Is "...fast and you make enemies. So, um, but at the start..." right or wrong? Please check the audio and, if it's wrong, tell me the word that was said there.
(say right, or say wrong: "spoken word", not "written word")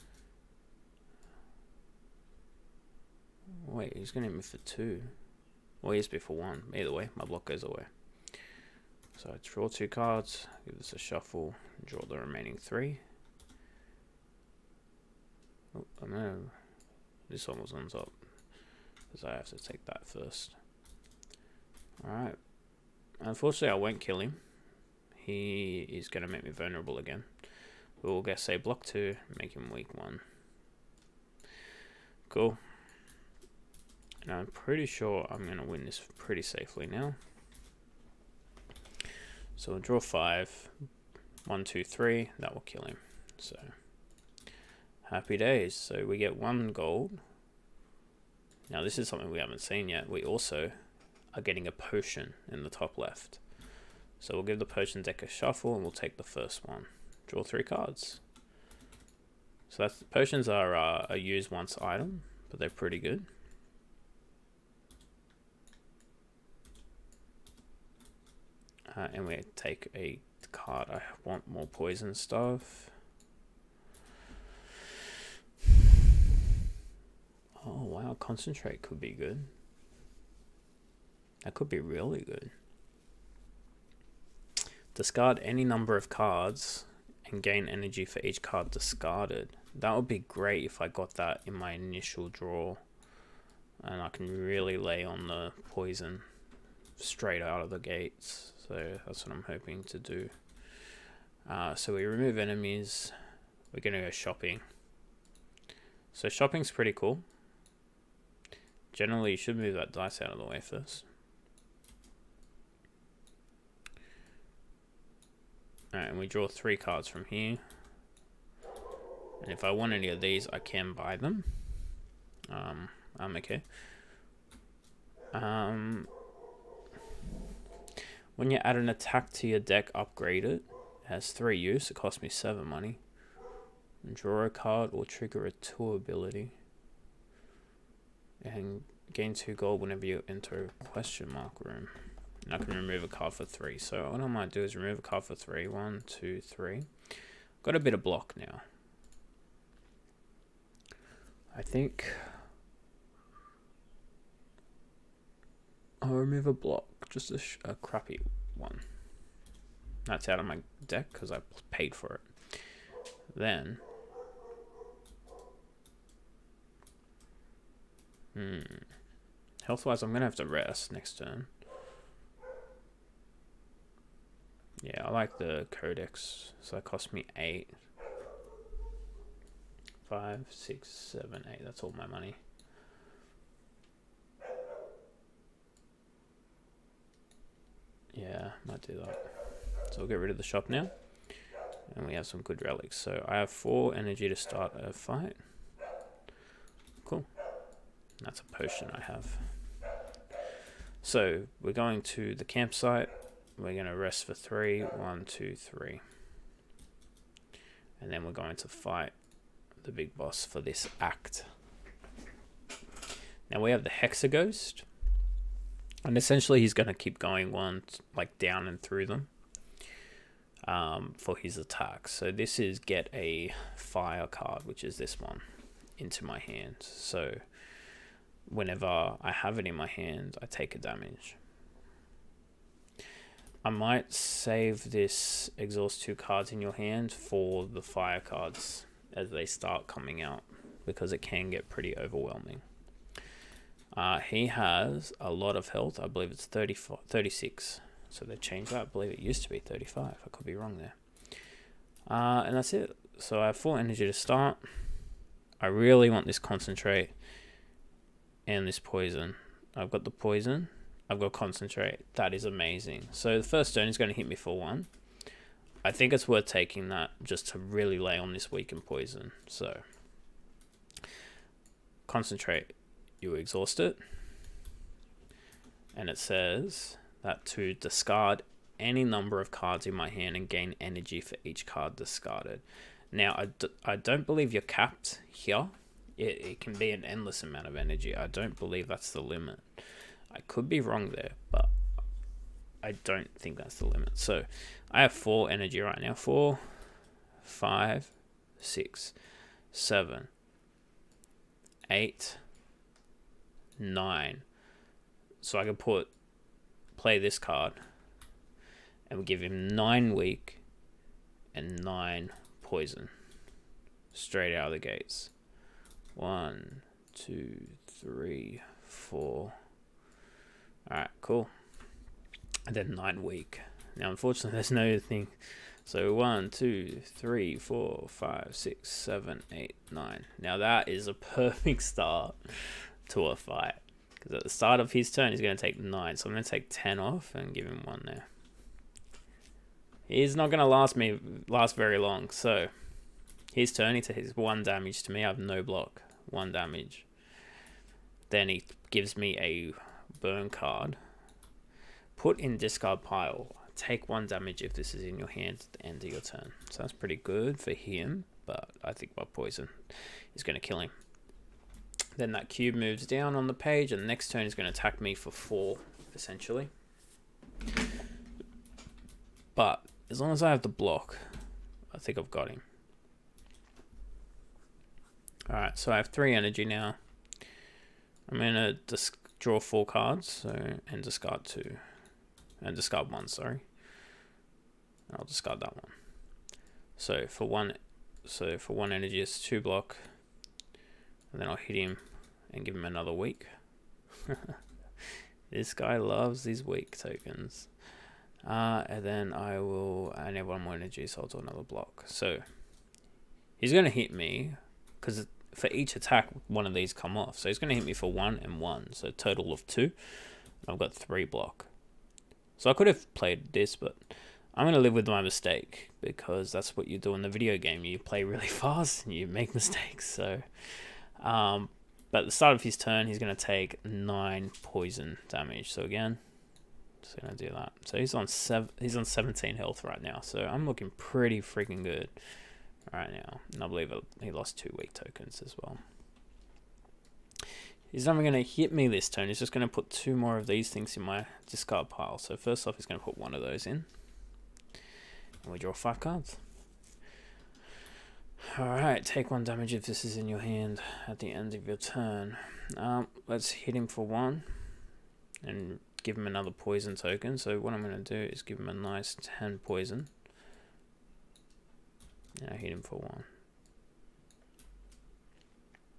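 wrong: "mistakes", not "enemies".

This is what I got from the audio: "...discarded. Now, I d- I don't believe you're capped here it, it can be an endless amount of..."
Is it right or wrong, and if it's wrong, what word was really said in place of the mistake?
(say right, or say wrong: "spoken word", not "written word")
right.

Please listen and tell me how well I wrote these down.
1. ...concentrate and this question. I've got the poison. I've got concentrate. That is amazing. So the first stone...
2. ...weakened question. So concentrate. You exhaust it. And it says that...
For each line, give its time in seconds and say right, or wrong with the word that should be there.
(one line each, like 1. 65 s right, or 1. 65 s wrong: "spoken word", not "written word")
1. 256 s wrong: "poison", not "question"
2. 268 s wrong: "poison", not "question".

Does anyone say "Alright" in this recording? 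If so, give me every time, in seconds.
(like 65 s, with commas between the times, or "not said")
22 s, 115 s, 448 s.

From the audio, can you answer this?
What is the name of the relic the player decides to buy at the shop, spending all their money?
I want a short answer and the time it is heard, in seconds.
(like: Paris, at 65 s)
Codex, at 175 s.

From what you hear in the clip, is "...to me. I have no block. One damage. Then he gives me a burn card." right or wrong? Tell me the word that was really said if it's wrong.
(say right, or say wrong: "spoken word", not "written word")
right.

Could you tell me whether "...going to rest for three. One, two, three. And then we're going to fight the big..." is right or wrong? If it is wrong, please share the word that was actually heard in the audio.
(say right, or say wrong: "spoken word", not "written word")
right.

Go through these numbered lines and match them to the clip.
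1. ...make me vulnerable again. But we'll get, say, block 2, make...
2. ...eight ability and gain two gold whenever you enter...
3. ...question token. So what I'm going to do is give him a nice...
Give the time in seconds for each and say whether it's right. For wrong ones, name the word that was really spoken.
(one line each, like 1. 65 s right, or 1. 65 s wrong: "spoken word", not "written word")
1. 26 s right
2. 135 s wrong: "two", not "eight"
3. 456 s wrong: "poison", not "question".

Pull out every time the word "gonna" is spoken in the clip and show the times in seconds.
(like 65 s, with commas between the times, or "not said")
378 s, 403 s.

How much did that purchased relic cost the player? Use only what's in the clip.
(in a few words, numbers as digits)
8.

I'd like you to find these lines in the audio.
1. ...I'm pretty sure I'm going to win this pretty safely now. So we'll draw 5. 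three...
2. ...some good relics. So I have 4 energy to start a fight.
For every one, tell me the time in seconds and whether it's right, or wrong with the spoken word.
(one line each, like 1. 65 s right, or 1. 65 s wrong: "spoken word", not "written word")
1. 34 s wrong: "two", not "three"
2. 192 s right.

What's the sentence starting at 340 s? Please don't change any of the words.
He's not going to last me last very long.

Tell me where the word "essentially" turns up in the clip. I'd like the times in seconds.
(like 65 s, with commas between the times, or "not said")
216 s, 366 s.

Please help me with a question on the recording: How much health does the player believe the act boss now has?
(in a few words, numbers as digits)
36.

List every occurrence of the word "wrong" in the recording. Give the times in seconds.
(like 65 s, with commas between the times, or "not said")
250 s, 290 s.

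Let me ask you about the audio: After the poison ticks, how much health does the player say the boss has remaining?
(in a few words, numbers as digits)
17.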